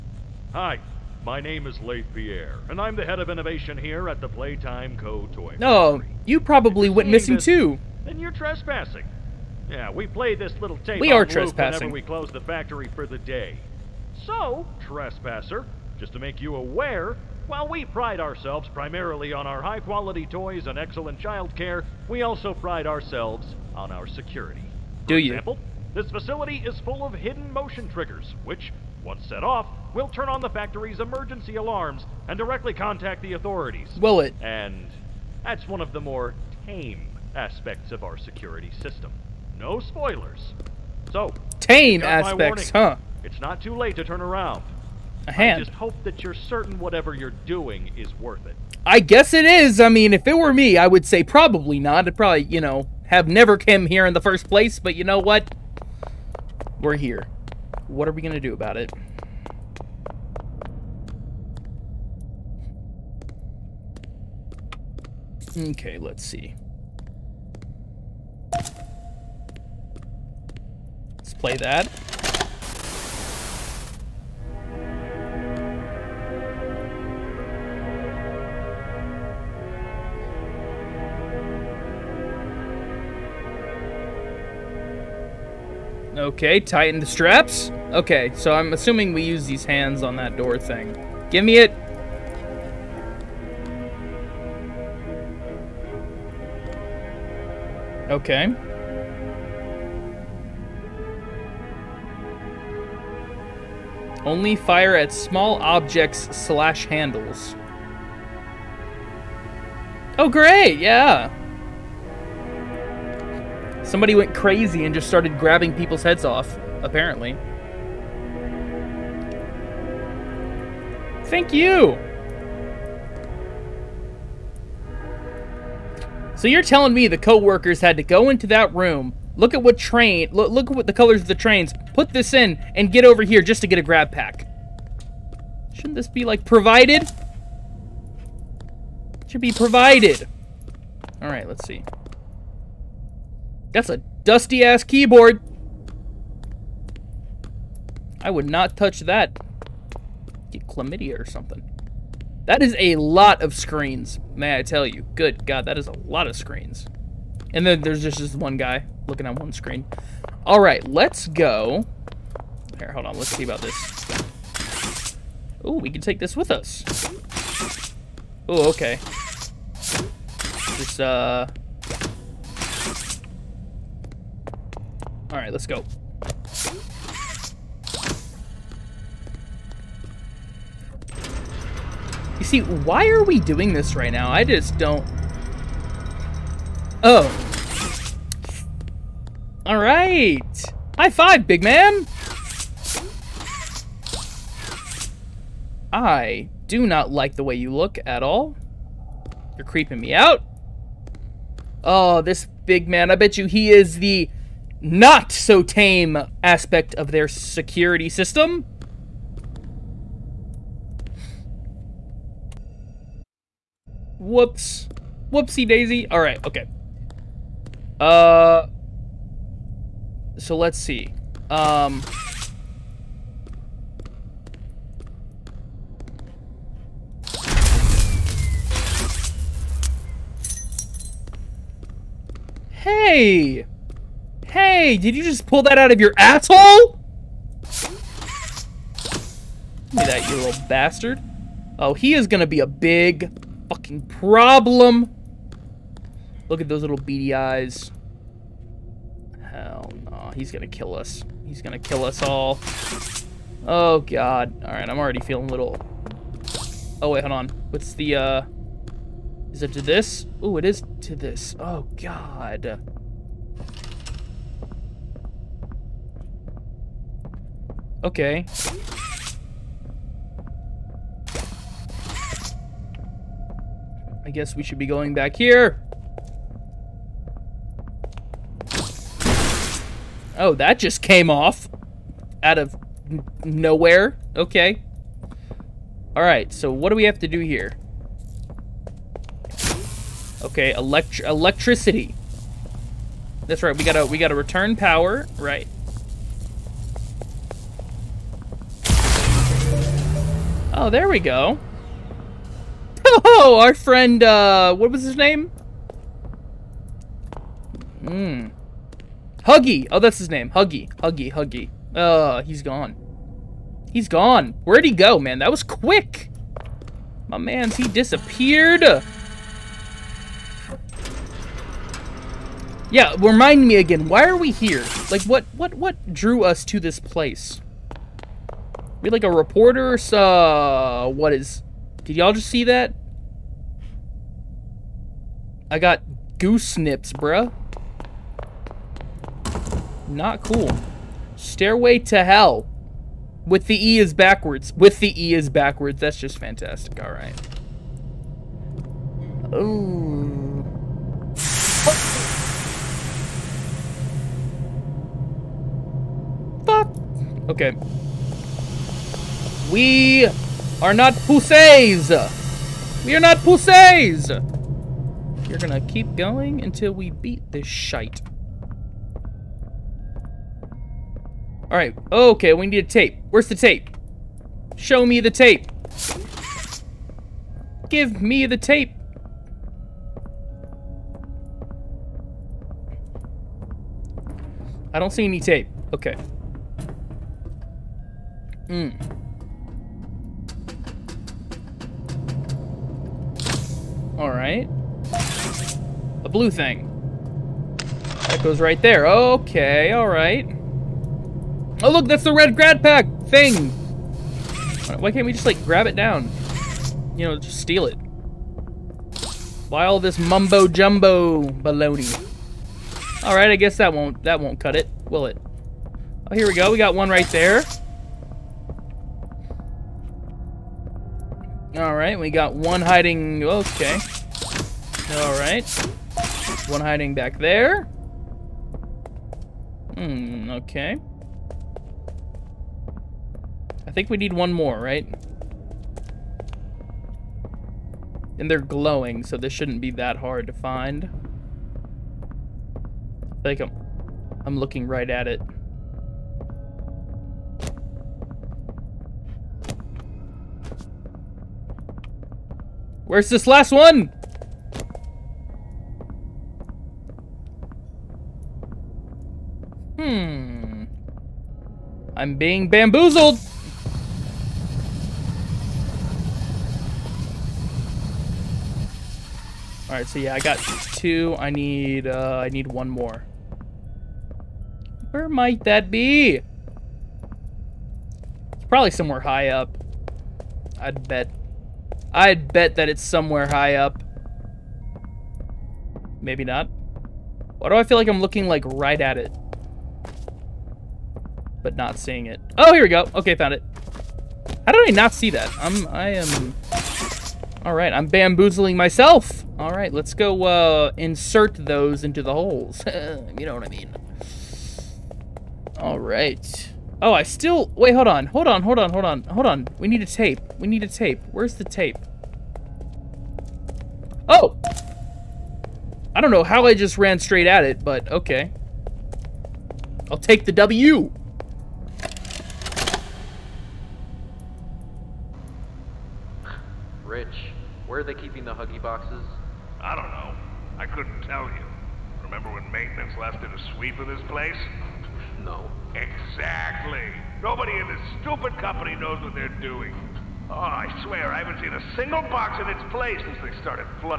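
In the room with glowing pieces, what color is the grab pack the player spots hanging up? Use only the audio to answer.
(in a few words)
Red.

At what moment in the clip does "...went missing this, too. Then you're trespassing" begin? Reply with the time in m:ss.
0:06.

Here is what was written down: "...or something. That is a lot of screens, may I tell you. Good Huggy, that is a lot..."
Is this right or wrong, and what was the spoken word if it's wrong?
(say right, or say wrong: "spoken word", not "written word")
wrong: "God", not "Huggy".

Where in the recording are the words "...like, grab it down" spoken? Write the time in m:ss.
6:45.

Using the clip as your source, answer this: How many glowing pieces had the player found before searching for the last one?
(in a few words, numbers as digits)
2.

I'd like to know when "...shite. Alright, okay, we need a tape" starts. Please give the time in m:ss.
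6:07.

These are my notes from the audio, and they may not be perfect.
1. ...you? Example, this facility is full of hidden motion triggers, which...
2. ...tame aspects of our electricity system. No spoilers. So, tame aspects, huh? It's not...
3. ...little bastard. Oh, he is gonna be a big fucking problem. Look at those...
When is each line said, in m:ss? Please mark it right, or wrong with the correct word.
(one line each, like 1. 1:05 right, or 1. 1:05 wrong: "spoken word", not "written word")
1. 0:25 right
2. 0:36 wrong: "security", not "electricity"
3. 4:00 right.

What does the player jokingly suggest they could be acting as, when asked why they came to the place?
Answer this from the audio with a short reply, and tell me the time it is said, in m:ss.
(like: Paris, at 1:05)
A reporter, at 5:29.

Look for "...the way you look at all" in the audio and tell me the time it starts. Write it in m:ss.
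3:17.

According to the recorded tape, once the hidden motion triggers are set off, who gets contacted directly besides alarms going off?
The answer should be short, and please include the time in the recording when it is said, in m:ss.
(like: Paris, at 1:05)
The authorities, at 0:33.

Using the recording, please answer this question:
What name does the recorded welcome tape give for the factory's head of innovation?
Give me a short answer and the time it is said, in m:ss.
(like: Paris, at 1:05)
Leith Pierre, at 0:01.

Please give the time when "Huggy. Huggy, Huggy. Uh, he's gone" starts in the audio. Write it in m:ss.
5:10.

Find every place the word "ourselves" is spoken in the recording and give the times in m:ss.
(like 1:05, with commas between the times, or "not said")
0:18, 0:22.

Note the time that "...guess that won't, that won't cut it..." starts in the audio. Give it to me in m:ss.
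6:53.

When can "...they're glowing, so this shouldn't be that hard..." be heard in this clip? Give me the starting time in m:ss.
7:18.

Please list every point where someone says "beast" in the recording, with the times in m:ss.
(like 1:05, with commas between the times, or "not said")
not said.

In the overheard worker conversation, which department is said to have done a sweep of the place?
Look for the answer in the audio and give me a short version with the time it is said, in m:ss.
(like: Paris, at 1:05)
Maintenance, at 8:52.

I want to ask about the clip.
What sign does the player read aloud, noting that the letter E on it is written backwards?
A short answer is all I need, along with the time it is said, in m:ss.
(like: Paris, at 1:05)
Stairway to Hell, at 5:41.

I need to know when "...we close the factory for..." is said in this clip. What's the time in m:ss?
0:11.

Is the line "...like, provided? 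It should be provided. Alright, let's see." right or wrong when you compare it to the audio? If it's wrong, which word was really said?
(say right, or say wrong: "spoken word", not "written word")
right.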